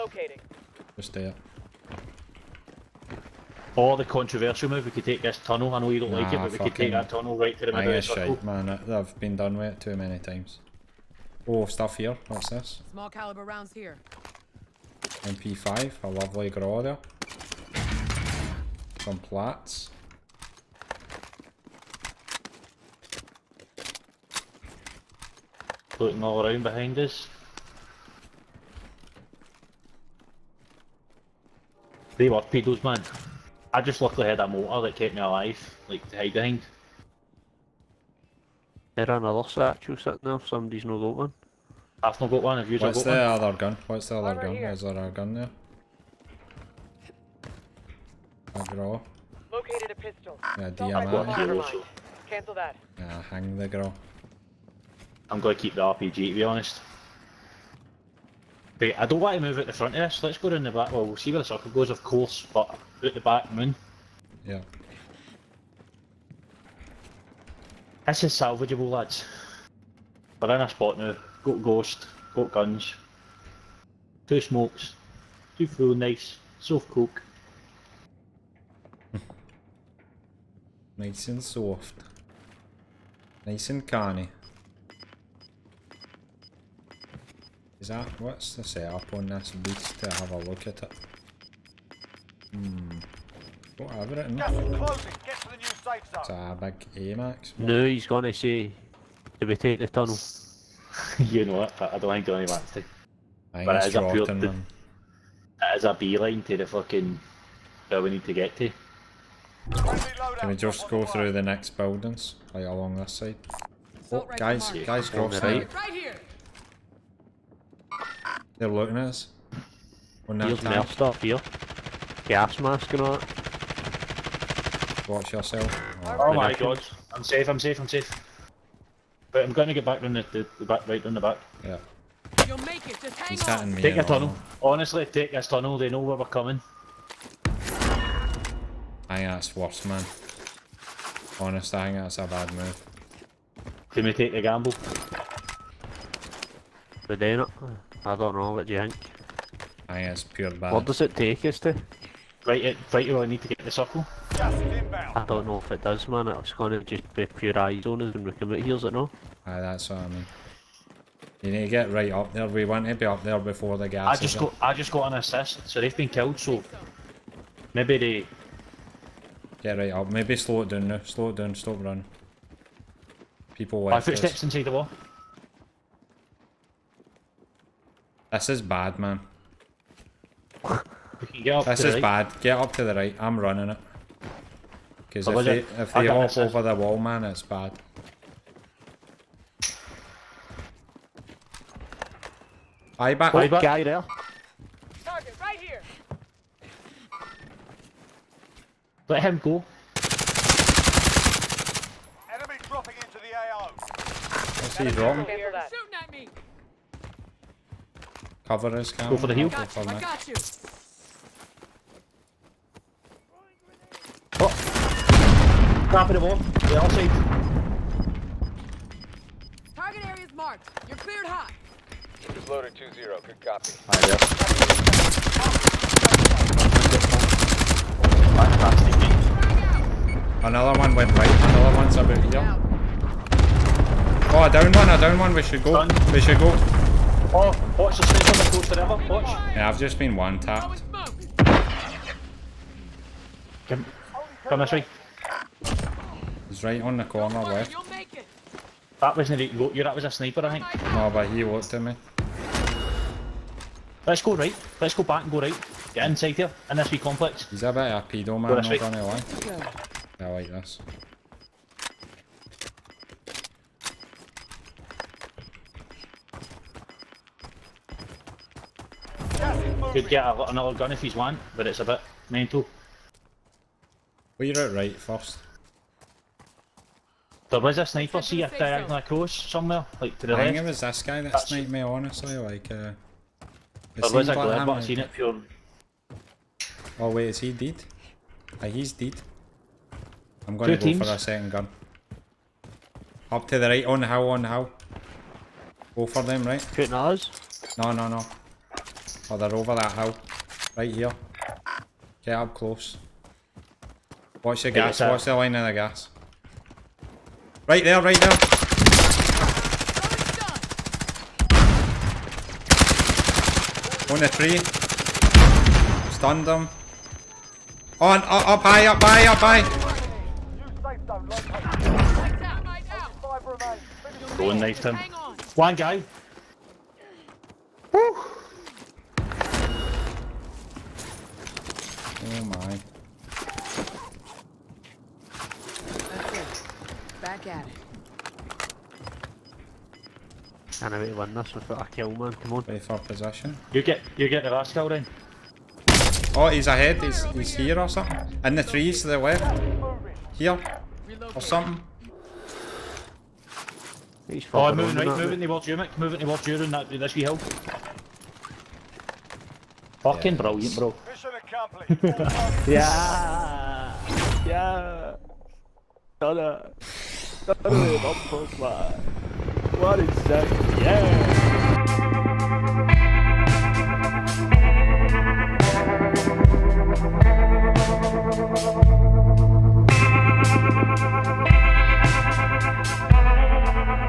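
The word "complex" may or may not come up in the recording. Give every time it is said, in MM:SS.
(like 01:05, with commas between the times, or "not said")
04:16.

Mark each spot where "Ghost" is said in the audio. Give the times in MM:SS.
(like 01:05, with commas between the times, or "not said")
01:11.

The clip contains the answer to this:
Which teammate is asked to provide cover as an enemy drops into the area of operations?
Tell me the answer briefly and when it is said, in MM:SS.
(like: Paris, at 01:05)
Cam, at 03:28.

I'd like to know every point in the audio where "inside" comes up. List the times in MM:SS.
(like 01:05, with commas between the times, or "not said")
02:54, 04:16.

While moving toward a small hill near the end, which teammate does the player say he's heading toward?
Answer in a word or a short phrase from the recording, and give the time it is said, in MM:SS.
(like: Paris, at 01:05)
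Mick, at 05:55.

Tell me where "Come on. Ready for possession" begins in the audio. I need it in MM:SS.
05:42.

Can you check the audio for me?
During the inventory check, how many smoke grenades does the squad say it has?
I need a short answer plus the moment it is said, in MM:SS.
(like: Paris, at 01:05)
2, at 01:14.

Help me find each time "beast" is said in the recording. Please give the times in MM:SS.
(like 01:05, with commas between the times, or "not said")
01:29.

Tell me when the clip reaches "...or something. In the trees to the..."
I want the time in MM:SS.
05:47.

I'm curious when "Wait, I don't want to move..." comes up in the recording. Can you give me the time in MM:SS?
00:58.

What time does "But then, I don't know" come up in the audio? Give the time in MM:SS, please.
02:27.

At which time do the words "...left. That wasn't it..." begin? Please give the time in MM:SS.
04:07.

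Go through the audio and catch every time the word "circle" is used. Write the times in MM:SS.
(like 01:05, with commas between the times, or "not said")
00:08, 01:01, 02:33.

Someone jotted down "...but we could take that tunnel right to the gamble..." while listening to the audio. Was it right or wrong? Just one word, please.
wrong.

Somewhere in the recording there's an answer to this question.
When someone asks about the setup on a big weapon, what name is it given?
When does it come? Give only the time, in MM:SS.
01:36.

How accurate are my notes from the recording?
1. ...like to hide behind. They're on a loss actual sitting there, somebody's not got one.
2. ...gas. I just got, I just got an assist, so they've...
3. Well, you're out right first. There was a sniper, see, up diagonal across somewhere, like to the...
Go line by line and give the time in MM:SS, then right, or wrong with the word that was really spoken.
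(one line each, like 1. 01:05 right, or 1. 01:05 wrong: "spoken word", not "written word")
1. 00:35 right
2. 02:43 right
3. 04:34 right.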